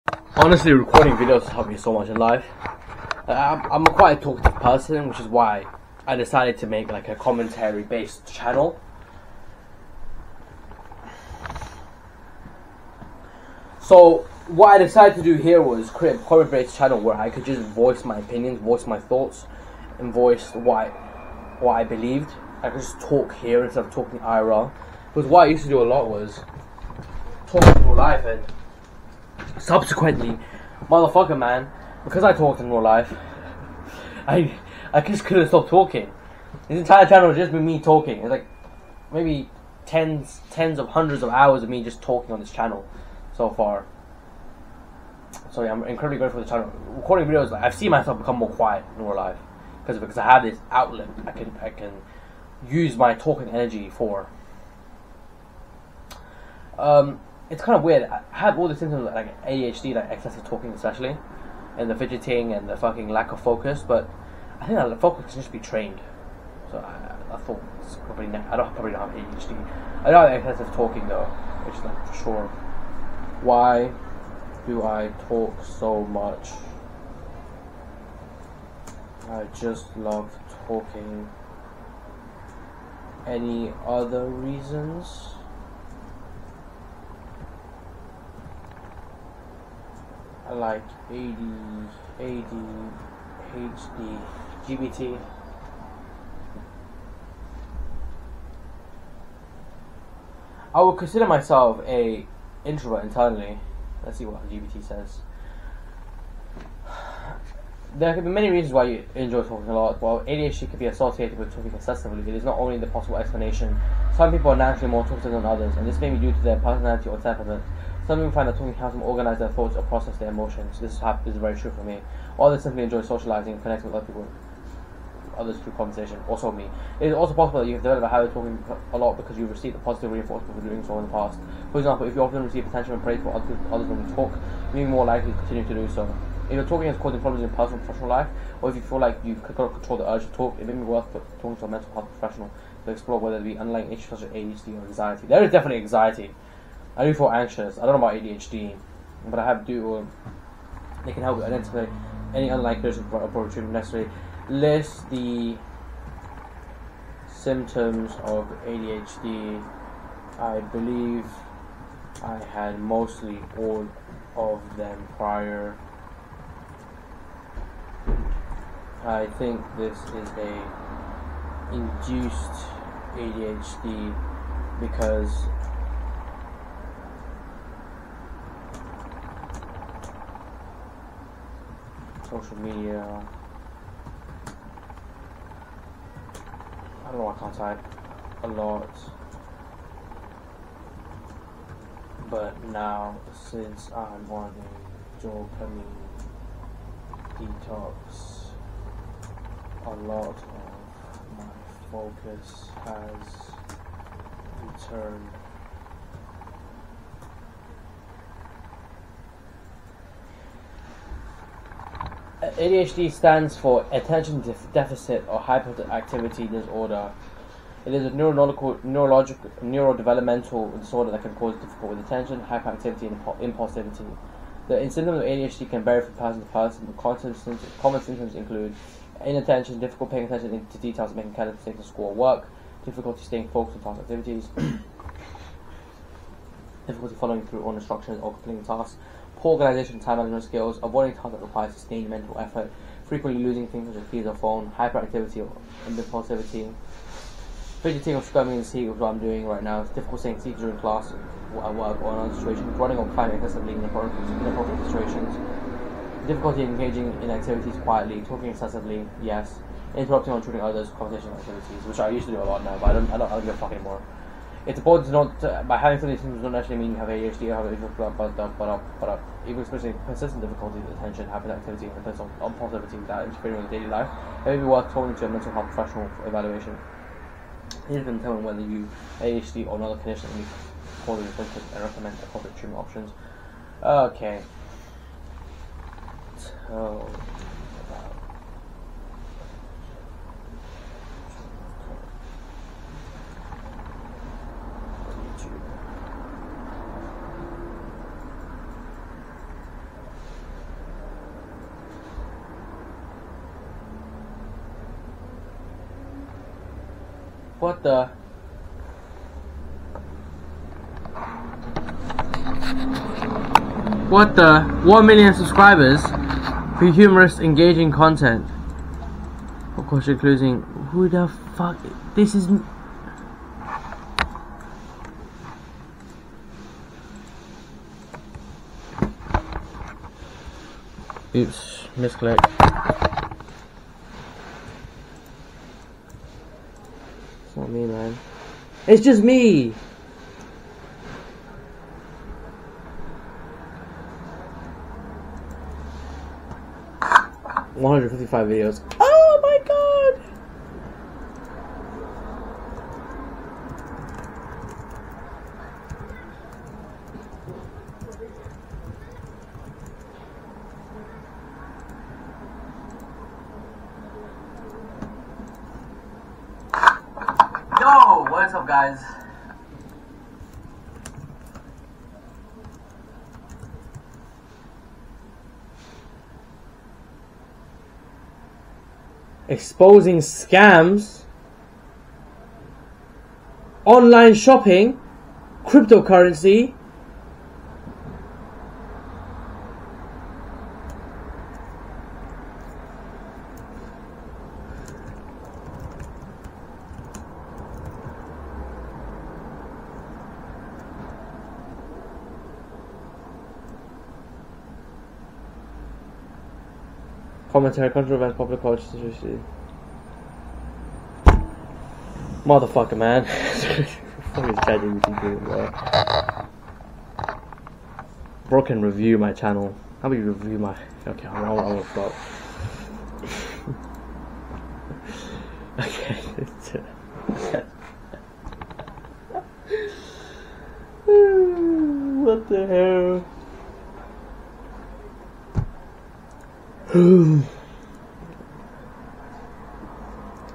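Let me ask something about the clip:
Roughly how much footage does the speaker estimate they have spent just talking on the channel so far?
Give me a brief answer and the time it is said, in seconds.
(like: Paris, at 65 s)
tens of hundreds of hours, at 40 s.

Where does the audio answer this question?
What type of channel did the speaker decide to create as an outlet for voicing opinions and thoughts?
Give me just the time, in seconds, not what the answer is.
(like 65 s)
7 s.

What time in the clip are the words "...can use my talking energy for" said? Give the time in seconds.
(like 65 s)
51 s.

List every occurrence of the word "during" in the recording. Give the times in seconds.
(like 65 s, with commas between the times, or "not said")
250 s.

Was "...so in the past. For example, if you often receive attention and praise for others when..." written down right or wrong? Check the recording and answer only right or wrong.
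right.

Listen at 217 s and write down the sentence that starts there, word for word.
It is a neurological, neurological, neurodevelopmental disorder that can cause difficulty with attention, hyperactivity, and impulsivity.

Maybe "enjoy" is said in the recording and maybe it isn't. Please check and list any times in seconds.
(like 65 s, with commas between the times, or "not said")
109 s, 122 s.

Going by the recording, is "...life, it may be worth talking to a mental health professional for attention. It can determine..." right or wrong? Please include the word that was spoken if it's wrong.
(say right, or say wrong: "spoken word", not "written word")
wrong: "evaluation", not "attention".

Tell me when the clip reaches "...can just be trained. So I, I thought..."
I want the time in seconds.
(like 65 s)
65 s.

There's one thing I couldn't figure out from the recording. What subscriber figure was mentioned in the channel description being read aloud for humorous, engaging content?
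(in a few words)
1 million.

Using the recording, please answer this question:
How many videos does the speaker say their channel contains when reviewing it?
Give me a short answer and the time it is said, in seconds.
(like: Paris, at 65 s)
155, at 347 s.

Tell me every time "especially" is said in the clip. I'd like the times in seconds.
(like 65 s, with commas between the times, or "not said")
60 s, 269 s.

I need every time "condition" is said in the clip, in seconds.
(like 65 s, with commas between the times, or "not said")
279 s.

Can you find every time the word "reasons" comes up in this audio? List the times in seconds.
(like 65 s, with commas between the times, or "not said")
84 s, 108 s.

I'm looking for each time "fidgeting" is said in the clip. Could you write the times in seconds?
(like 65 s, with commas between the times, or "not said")
61 s, 247 s.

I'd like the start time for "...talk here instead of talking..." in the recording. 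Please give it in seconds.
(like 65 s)
22 s.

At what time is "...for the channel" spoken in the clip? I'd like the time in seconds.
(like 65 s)
46 s.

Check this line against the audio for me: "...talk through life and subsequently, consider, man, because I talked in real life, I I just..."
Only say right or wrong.
wrong.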